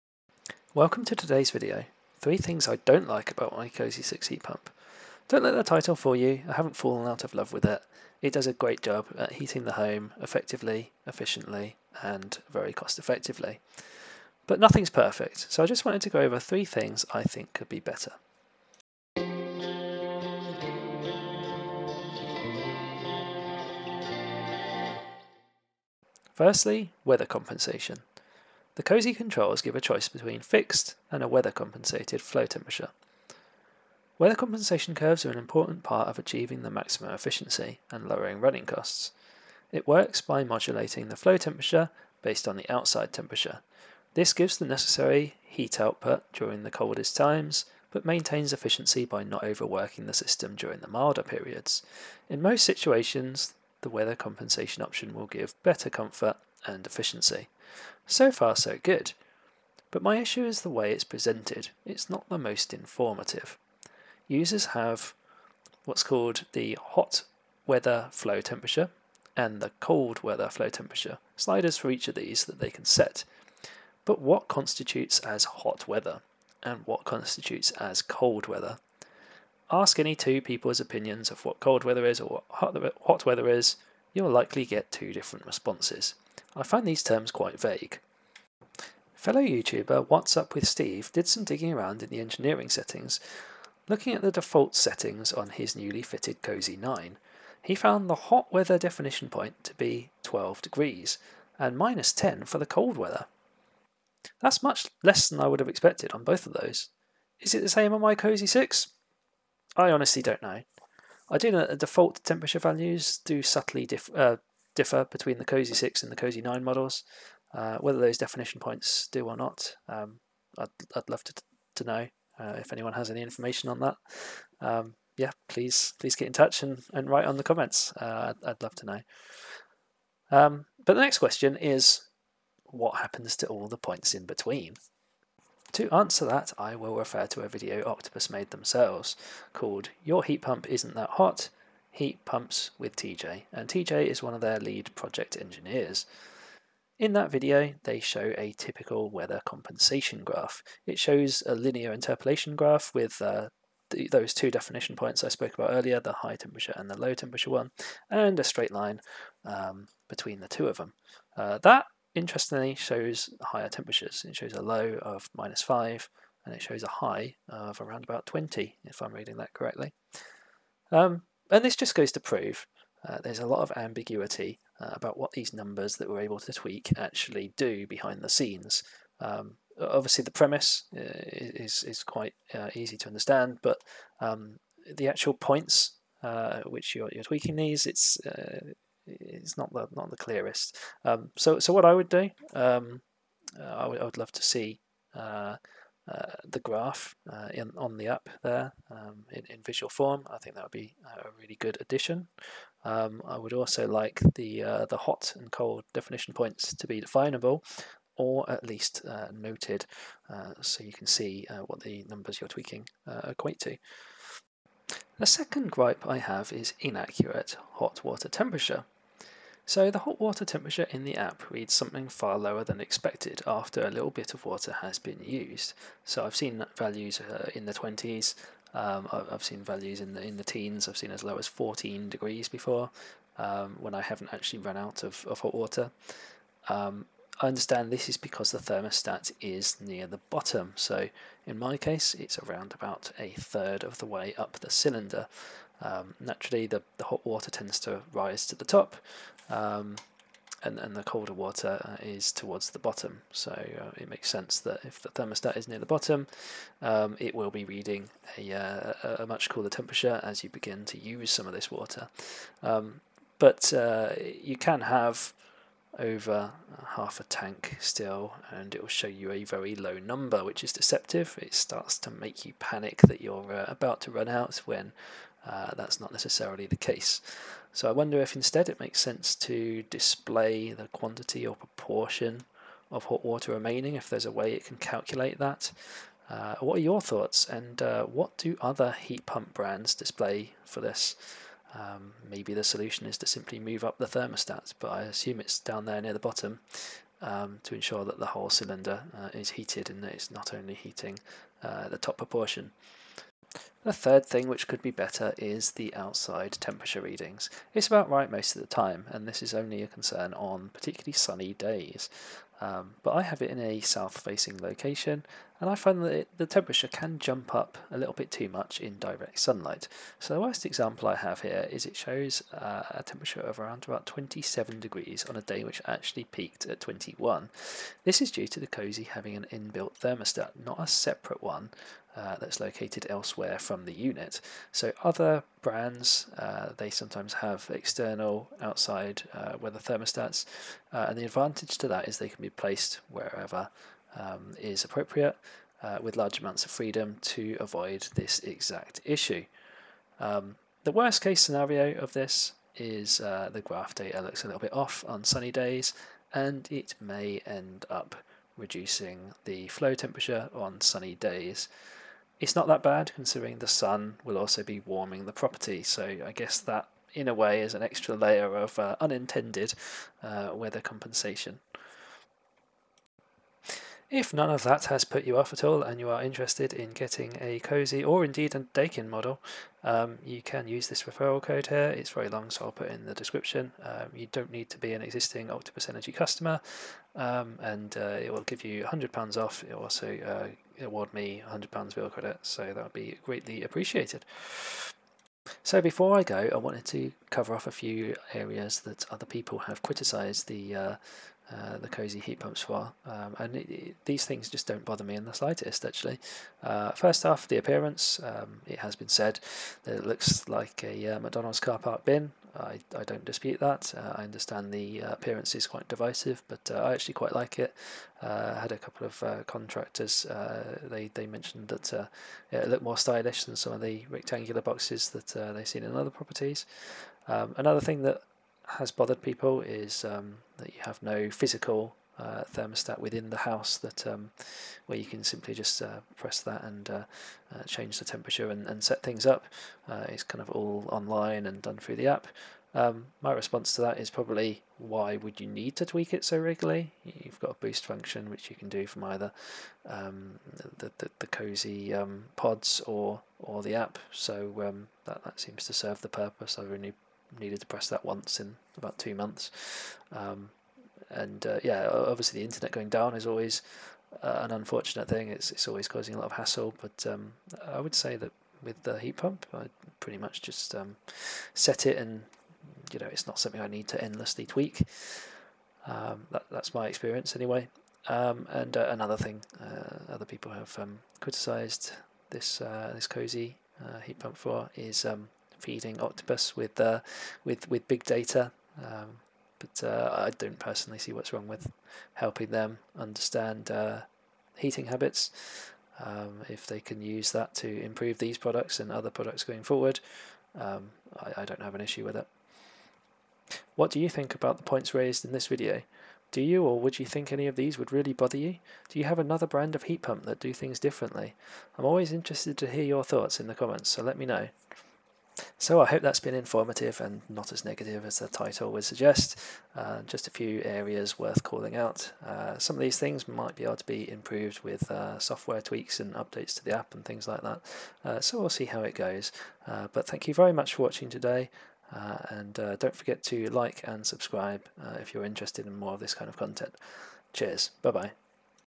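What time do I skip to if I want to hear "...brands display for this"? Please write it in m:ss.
4:49.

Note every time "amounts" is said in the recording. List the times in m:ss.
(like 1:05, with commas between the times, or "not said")
5:46.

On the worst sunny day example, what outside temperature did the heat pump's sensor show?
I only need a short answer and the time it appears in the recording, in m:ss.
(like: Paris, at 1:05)
27 degrees, at 5:24.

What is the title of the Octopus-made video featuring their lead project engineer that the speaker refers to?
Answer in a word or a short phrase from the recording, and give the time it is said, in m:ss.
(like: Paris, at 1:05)
Your Heat Pump Isn't That Hot, at 2:20.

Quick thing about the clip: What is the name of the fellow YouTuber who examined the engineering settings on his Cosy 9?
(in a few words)
Watts Up With Steve.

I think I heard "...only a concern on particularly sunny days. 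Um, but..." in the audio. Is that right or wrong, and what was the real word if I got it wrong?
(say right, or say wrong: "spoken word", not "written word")
right.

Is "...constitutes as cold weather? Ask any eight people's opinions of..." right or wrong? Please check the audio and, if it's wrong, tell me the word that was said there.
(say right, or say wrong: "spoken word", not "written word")
wrong: "two", not "eight".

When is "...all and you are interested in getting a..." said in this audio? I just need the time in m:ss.
6:15.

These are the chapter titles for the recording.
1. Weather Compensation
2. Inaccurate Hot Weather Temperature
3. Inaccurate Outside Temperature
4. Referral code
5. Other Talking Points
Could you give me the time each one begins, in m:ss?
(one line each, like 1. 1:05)
1. 0:26
2. 3:35
3. 5:04
4. 6:13
5. 6:36.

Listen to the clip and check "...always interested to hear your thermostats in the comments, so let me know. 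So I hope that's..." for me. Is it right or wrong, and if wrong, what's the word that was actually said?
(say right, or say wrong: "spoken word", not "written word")
wrong: "thoughts", not "thermostats".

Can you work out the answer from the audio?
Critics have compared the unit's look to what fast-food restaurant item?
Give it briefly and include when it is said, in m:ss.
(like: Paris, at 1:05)
McDonald's car park bin, at 6:51.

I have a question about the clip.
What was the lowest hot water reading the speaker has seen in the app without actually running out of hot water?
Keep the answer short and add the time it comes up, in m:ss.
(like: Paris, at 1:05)
14 degrees, at 3:51.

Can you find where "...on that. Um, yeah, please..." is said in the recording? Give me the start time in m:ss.
2:03.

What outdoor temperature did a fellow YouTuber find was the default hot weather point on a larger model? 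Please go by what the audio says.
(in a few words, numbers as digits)
12 degrees.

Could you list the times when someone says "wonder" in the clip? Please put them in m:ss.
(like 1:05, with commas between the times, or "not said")
4:37.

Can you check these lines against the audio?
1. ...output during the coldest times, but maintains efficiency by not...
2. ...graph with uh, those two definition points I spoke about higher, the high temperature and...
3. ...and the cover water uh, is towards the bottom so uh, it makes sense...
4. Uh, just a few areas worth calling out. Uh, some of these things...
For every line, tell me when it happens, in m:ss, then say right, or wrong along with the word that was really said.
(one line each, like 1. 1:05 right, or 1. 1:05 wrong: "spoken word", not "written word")
1. 0:45 right
2. 2:32 wrong: "earlier", not "higher"
3. 4:10 wrong: "colder", not "cover"
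4. 8:39 right.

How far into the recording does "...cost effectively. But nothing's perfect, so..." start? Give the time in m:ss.
0:12.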